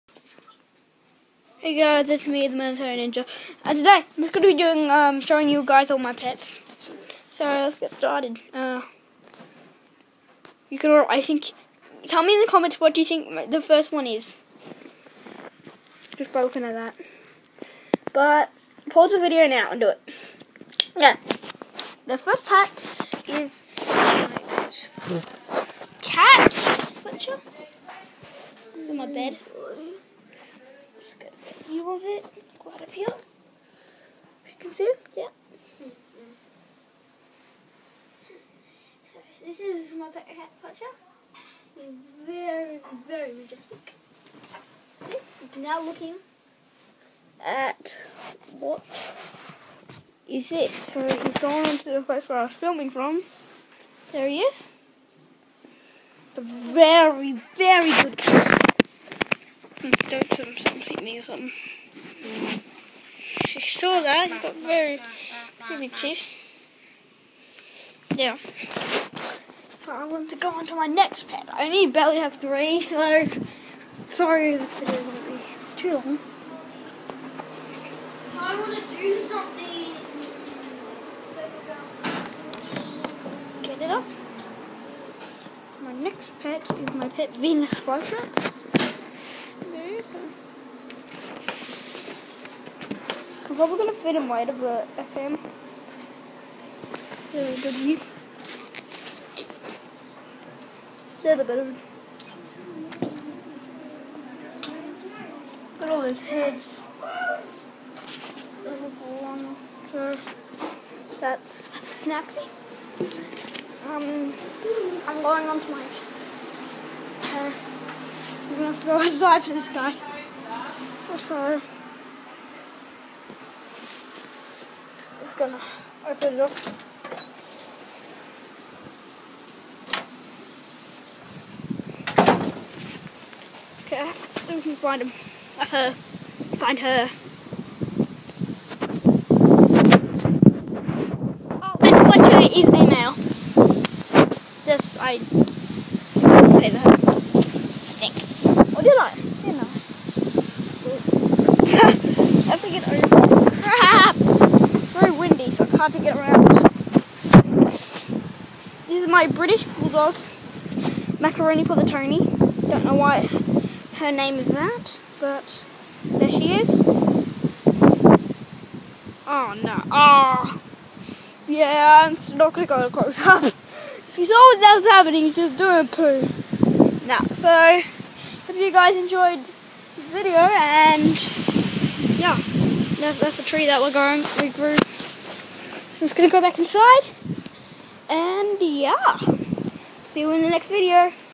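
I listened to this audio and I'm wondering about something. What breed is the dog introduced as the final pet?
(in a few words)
British Bulldog.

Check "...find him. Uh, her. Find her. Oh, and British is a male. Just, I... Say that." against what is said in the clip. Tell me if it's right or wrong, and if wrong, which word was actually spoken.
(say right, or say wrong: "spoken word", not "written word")
wrong: "Fletcher", not "British".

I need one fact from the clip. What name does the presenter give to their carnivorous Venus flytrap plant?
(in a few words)
Snappy.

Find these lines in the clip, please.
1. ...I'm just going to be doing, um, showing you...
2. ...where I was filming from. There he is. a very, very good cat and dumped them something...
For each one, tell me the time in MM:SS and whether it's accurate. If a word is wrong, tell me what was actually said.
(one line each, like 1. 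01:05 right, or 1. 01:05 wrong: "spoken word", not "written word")
1. 00:04 right
2. 00:52 right.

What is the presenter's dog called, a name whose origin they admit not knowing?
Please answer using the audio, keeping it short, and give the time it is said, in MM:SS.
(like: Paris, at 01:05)
Macaroni, at 02:41.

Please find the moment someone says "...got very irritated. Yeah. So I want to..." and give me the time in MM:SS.
01:04.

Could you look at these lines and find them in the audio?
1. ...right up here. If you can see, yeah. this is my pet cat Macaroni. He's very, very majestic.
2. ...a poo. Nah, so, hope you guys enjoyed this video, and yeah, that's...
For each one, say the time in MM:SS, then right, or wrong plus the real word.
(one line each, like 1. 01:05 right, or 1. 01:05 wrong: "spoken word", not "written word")
1. 00:32 wrong: "Fletcher", not "Macaroni"
2. 02:55 right.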